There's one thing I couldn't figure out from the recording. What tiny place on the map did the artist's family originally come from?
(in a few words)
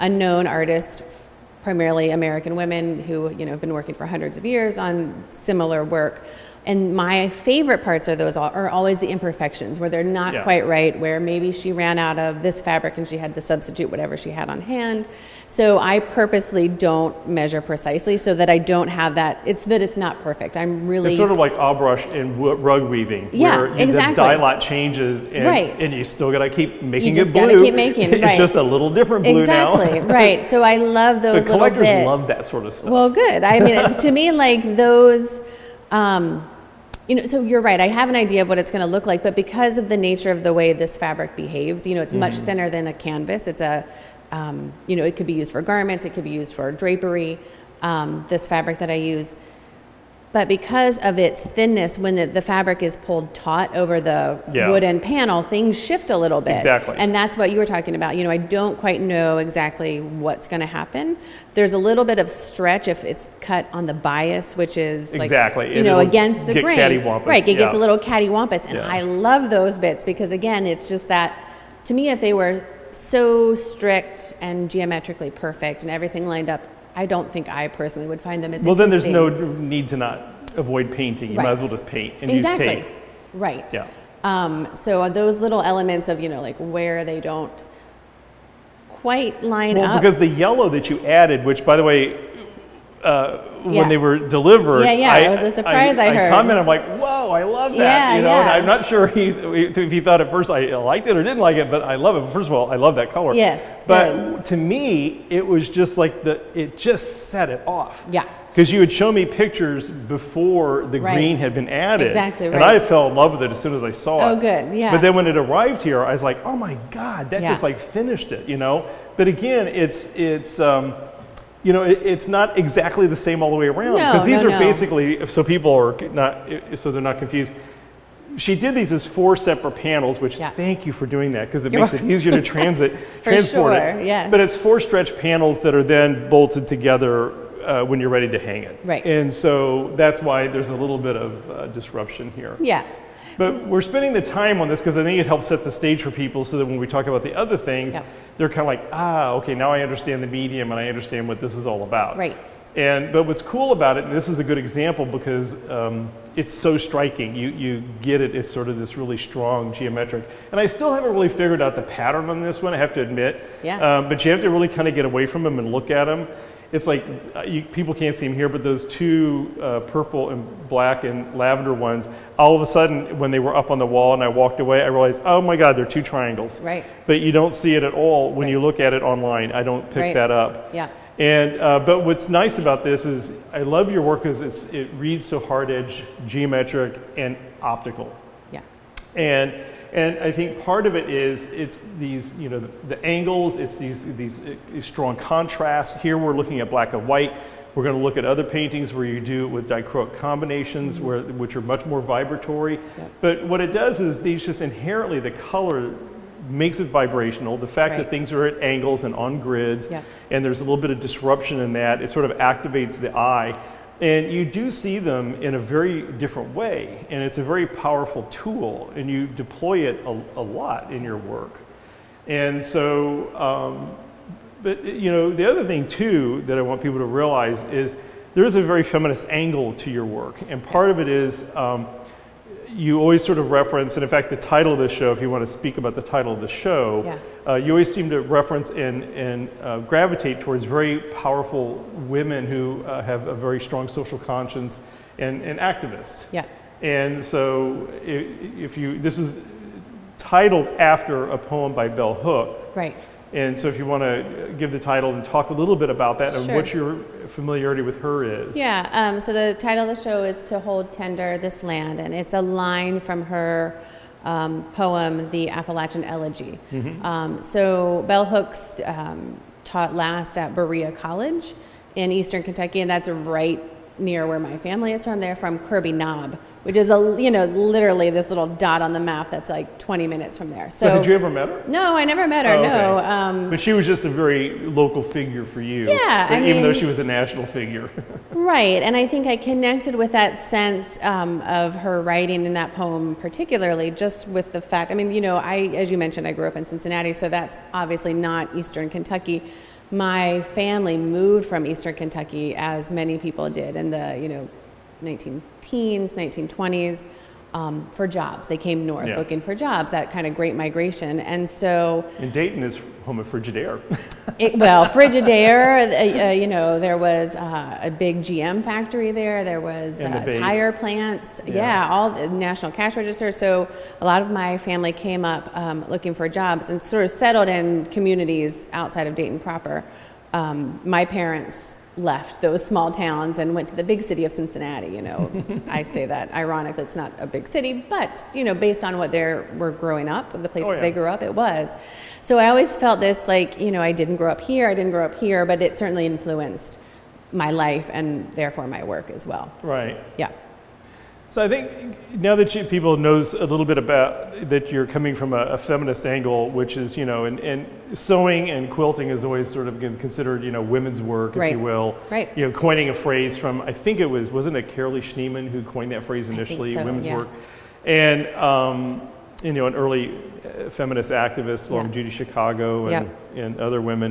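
Kirby Knob.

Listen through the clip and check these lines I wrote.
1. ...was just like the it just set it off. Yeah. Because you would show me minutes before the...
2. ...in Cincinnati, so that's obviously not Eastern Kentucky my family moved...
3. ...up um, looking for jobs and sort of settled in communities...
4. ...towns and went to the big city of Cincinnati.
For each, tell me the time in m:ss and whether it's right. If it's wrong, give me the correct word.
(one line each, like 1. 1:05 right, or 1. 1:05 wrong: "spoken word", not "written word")
1. 1:45 wrong: "pictures", not "minutes"
2. 4:56 right
3. 5:25 right
4. 5:32 right.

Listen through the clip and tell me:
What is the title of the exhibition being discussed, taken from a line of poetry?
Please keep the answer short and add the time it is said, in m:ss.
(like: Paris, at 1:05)
To Hold Tender This Land, at 4:20.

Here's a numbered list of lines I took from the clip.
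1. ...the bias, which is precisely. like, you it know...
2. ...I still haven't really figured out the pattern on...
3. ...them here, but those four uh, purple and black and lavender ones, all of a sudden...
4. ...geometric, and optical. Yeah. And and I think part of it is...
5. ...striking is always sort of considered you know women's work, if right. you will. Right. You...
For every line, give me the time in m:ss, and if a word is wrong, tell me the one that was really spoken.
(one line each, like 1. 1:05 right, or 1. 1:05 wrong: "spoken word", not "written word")
1. 1:03 wrong: "exactly", not "precisely"
2. 2:40 right
3. 2:48 wrong: "two", not "four"
4. 3:06 right
5. 5:58 wrong: "quilting", not "striking".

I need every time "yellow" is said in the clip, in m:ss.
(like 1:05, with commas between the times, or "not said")
1:30.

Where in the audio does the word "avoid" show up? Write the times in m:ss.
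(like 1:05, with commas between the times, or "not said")
1:20.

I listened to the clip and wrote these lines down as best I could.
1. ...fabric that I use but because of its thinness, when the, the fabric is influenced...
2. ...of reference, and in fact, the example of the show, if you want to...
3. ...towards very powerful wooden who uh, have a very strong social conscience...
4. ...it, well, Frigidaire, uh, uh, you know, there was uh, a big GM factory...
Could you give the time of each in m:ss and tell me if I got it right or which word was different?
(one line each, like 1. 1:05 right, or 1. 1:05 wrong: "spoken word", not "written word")
1. 0:48 wrong: "pulled", not "influenced"
2. 3:53 wrong: "title", not "example"
3. 4:00 wrong: "women", not "wooden"
4. 5:14 right.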